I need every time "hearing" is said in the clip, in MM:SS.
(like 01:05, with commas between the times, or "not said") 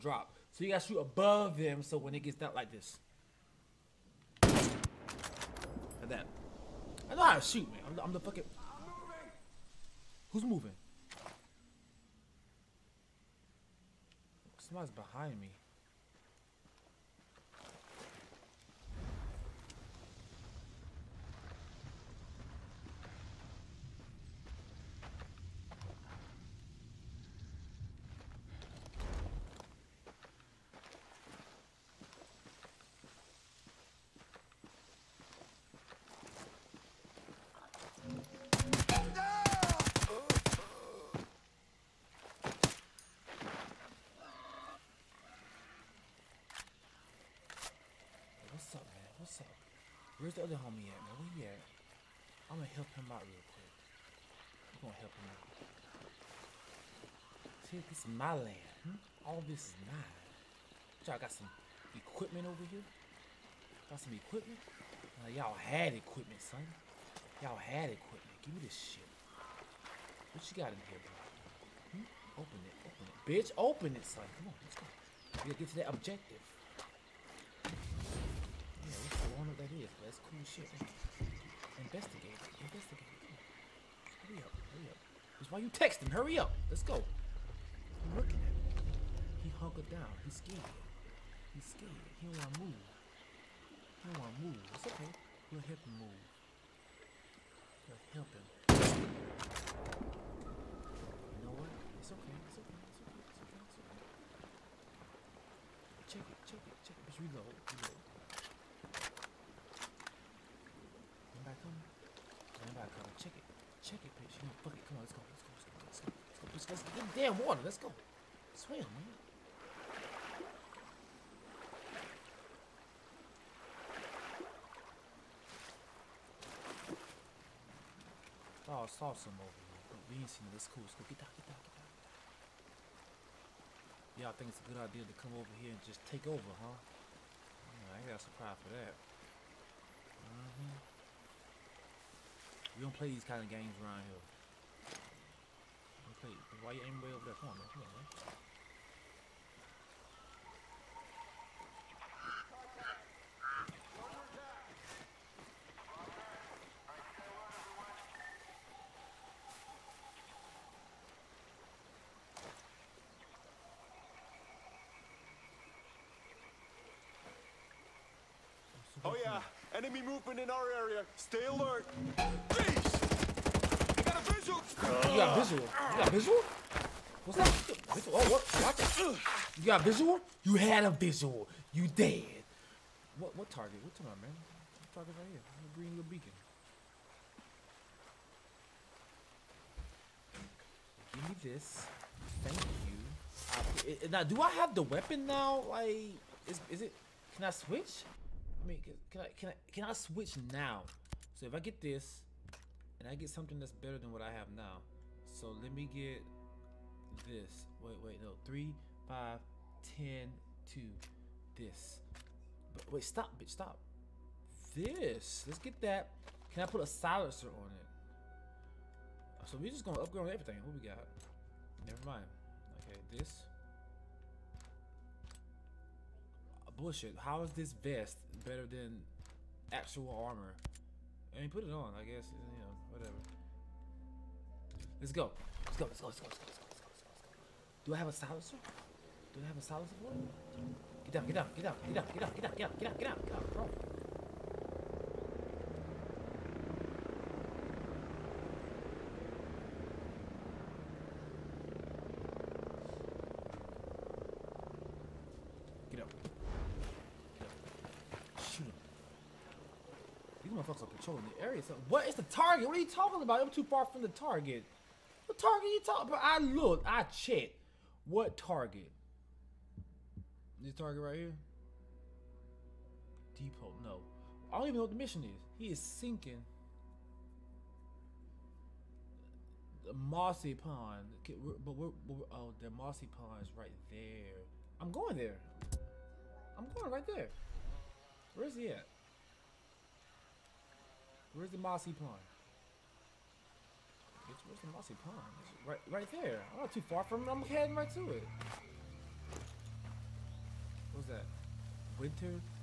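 not said.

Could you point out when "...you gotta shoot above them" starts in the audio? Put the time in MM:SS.
00:00.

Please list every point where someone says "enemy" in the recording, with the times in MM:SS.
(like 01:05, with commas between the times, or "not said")
02:49.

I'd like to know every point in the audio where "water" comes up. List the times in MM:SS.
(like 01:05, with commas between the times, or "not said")
01:57.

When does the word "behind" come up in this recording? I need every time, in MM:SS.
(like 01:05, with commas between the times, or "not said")
00:14.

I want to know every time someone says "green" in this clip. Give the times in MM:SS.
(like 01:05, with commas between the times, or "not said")
03:05.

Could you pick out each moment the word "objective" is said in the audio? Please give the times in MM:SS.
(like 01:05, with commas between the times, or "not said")
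01:15.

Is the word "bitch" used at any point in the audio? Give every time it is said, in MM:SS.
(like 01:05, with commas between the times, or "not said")
01:13, 01:54, 03:33, 04:54.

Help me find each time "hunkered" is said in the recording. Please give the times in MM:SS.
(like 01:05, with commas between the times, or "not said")
01:29.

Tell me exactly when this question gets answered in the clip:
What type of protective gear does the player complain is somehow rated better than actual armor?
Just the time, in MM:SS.
03:47.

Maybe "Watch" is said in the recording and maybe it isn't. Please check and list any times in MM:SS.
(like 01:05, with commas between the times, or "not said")
02:58.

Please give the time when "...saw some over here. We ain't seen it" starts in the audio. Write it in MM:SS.
02:08.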